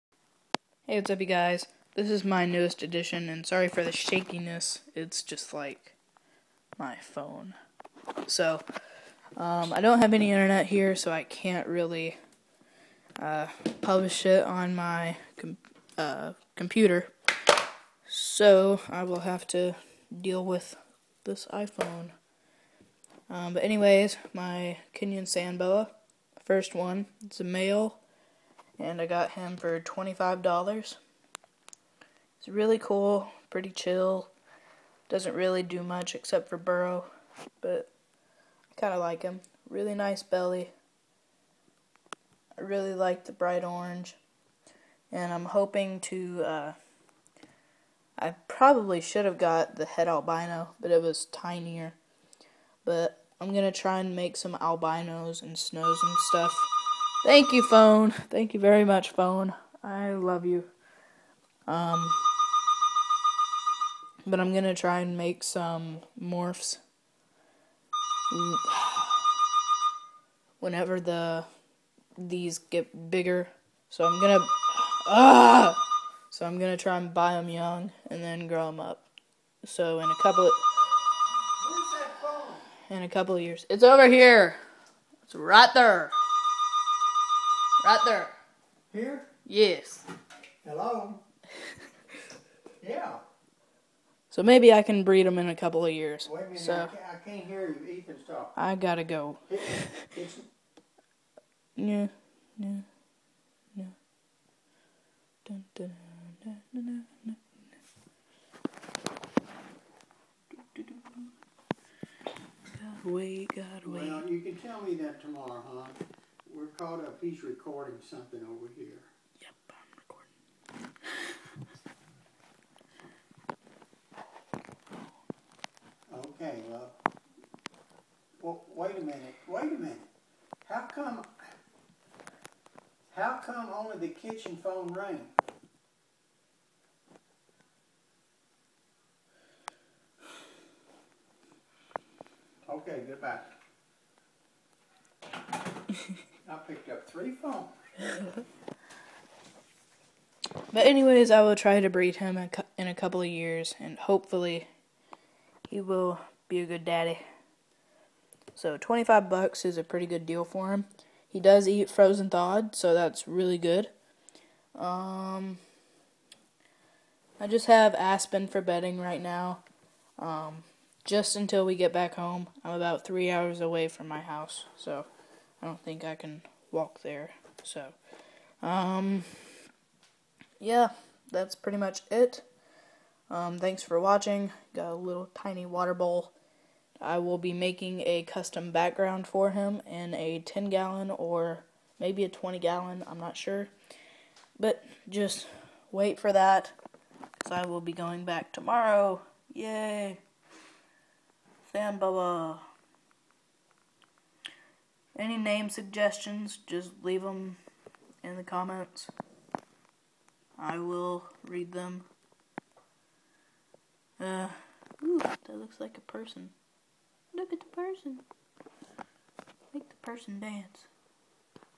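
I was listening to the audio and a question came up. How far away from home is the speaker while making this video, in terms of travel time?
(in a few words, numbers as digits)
3 hours.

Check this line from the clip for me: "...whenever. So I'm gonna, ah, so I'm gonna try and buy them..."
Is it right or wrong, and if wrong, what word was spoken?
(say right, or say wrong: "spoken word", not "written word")
wrong: "bigger", not "whenever".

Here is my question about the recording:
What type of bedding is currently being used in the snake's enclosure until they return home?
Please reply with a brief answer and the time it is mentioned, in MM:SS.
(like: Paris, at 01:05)
Aspen, at 02:47.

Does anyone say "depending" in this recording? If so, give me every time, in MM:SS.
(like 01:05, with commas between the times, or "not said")
not said.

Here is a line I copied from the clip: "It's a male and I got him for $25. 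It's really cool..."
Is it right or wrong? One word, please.
right.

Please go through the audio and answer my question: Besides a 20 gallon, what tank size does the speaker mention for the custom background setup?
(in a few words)
10 gallon.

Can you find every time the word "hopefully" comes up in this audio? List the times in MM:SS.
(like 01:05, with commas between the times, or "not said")
02:33.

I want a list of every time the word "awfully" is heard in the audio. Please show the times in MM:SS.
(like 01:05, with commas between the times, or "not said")
not said.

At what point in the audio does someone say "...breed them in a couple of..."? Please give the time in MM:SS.
01:35.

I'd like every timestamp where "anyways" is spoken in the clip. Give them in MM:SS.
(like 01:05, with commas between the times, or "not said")
00:23, 02:30.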